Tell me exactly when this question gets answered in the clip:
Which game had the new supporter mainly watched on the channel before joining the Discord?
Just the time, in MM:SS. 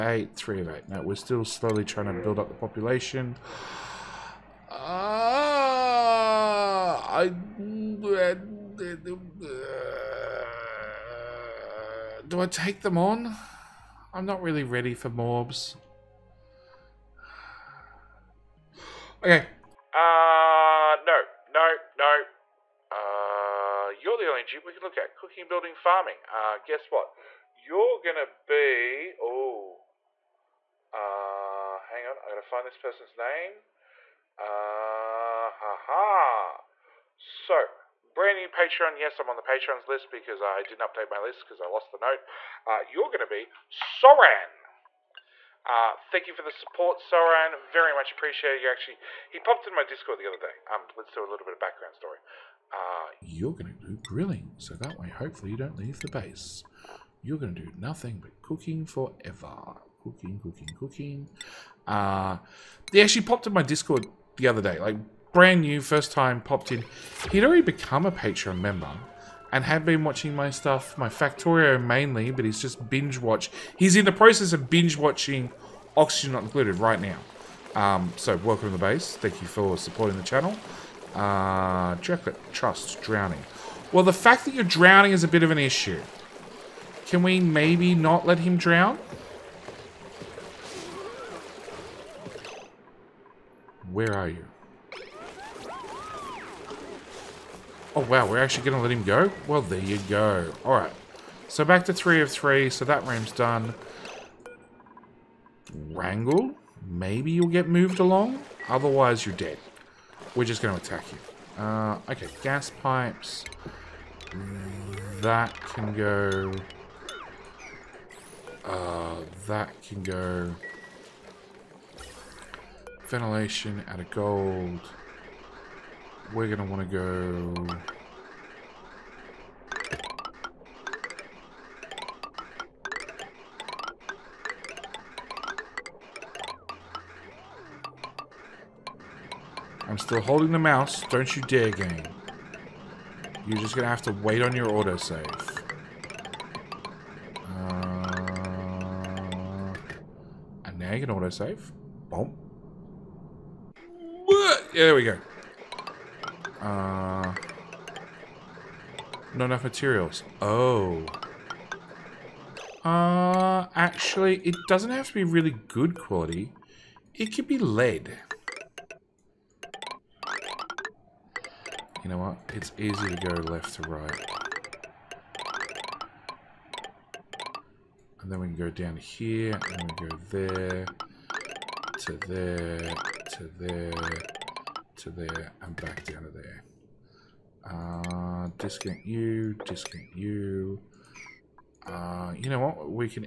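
01:11.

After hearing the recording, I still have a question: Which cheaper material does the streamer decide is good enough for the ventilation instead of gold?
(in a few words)
lead.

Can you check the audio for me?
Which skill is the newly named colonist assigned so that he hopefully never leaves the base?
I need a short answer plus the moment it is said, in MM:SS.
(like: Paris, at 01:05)
grilling, at 00:54.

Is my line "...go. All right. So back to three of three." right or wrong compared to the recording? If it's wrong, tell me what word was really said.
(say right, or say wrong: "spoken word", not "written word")
right.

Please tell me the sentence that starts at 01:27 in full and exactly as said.
Can we maybe not let him drown?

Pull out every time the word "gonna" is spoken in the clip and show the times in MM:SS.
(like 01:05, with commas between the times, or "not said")
00:27, 00:43.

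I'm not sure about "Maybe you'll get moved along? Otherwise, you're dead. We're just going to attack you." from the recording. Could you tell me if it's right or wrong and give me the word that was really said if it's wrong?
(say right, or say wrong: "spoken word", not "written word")
right.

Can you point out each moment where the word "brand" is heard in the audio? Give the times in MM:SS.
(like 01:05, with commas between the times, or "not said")
00:37, 01:05.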